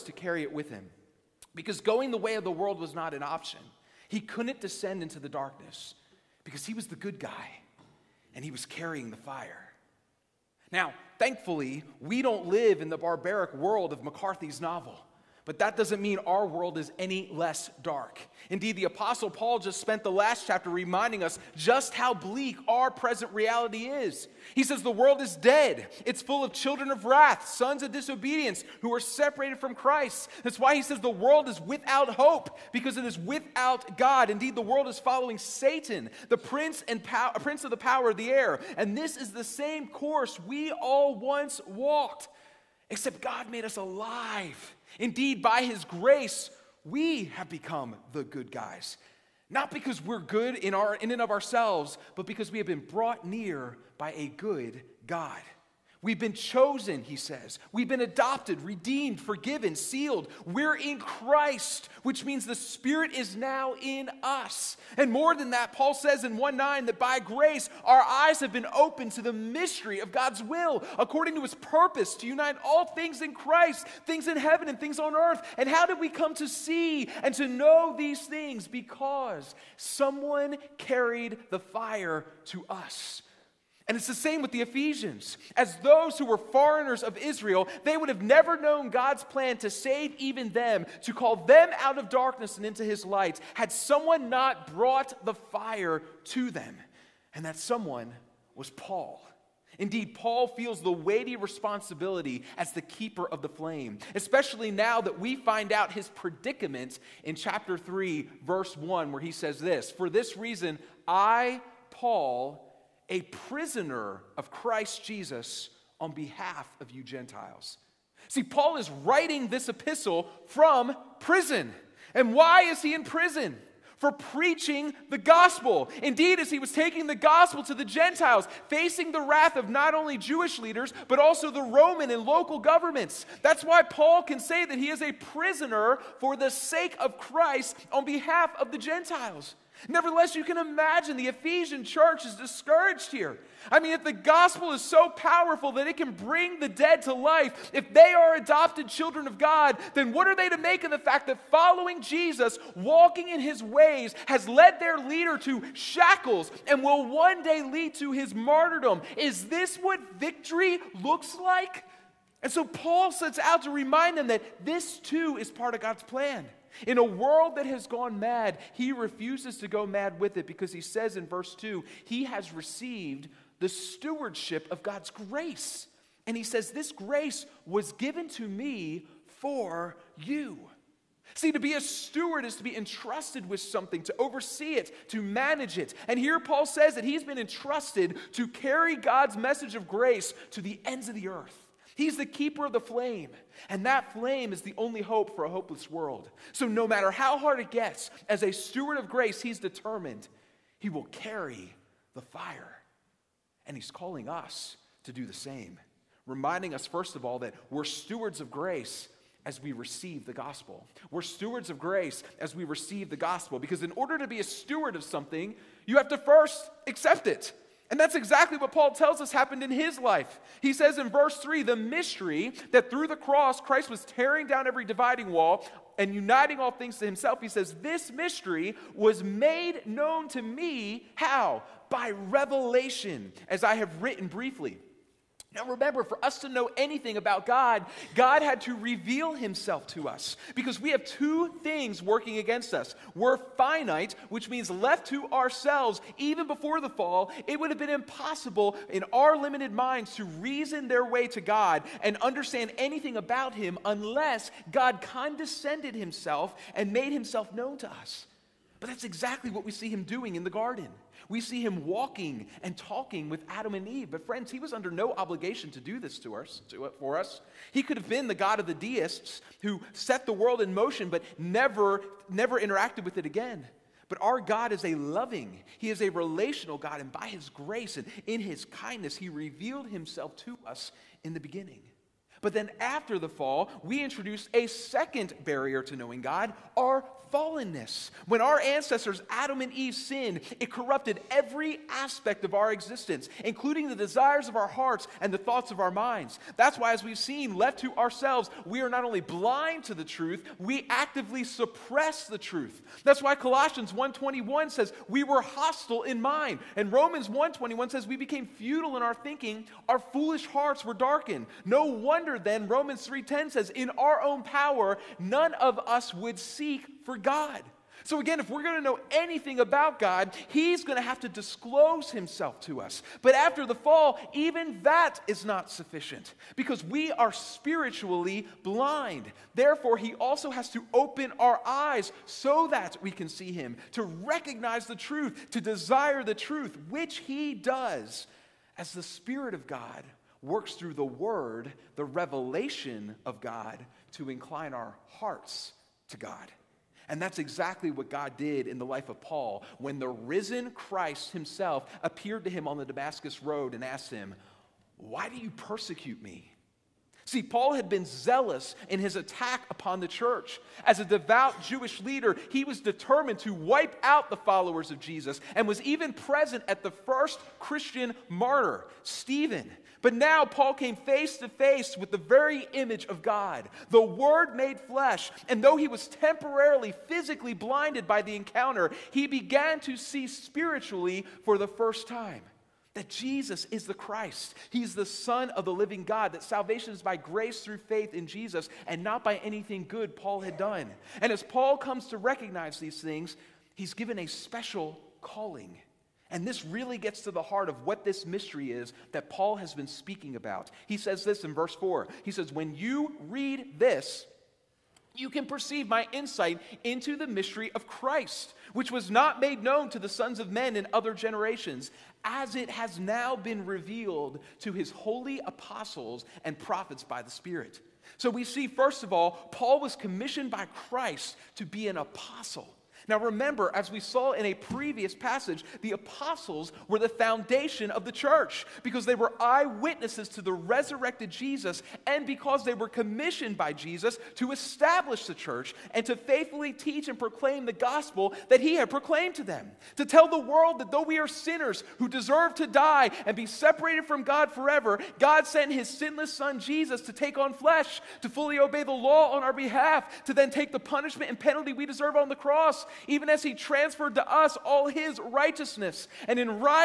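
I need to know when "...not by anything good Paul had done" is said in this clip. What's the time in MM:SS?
06:29.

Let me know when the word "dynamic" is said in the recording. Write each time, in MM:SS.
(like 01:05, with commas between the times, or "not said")
not said.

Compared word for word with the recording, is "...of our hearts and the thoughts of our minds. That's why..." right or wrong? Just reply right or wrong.
right.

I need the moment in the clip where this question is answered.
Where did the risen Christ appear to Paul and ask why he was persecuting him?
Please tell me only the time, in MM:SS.
05:52.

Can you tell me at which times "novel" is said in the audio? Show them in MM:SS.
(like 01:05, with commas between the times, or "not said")
00:14.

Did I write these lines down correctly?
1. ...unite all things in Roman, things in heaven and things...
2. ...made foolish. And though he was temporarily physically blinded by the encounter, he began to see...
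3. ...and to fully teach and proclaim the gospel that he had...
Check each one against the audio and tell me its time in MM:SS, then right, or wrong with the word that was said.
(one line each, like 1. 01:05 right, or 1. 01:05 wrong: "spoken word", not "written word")
1. 01:12 wrong: "Christ", not "Roman"
2. 06:14 wrong: "flesh", not "foolish"
3. 07:15 wrong: "faithfully", not "fully".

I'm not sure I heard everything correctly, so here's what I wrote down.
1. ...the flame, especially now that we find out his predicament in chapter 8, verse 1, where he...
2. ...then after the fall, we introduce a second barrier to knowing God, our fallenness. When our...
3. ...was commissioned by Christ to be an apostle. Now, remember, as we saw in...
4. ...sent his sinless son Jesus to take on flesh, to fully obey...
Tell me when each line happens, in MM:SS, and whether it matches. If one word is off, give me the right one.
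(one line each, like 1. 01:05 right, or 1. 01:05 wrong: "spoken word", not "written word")
1. 01:43 wrong: "3", not "8"
2. 04:42 right
3. 06:59 right
4. 07:25 right.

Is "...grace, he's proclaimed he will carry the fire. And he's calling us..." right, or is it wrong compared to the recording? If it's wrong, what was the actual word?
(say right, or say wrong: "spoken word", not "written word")
wrong: "determined", not "proclaimed".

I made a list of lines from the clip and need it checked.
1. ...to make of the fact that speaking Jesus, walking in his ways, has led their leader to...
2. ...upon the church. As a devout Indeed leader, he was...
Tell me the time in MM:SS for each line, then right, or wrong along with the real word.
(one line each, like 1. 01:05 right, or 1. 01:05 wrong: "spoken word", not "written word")
1. 02:30 wrong: "following", not "speaking"
2. 05:59 wrong: "Jewish", not "Indeed".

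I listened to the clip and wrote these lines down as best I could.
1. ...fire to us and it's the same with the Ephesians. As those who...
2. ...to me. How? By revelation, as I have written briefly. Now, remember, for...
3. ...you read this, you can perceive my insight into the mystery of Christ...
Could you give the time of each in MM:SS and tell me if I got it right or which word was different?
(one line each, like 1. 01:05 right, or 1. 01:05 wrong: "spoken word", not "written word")
1. 01:21 right
2. 03:50 right
3. 06:42 right.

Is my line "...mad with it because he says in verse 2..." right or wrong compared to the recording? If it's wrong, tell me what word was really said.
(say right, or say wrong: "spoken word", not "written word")
right.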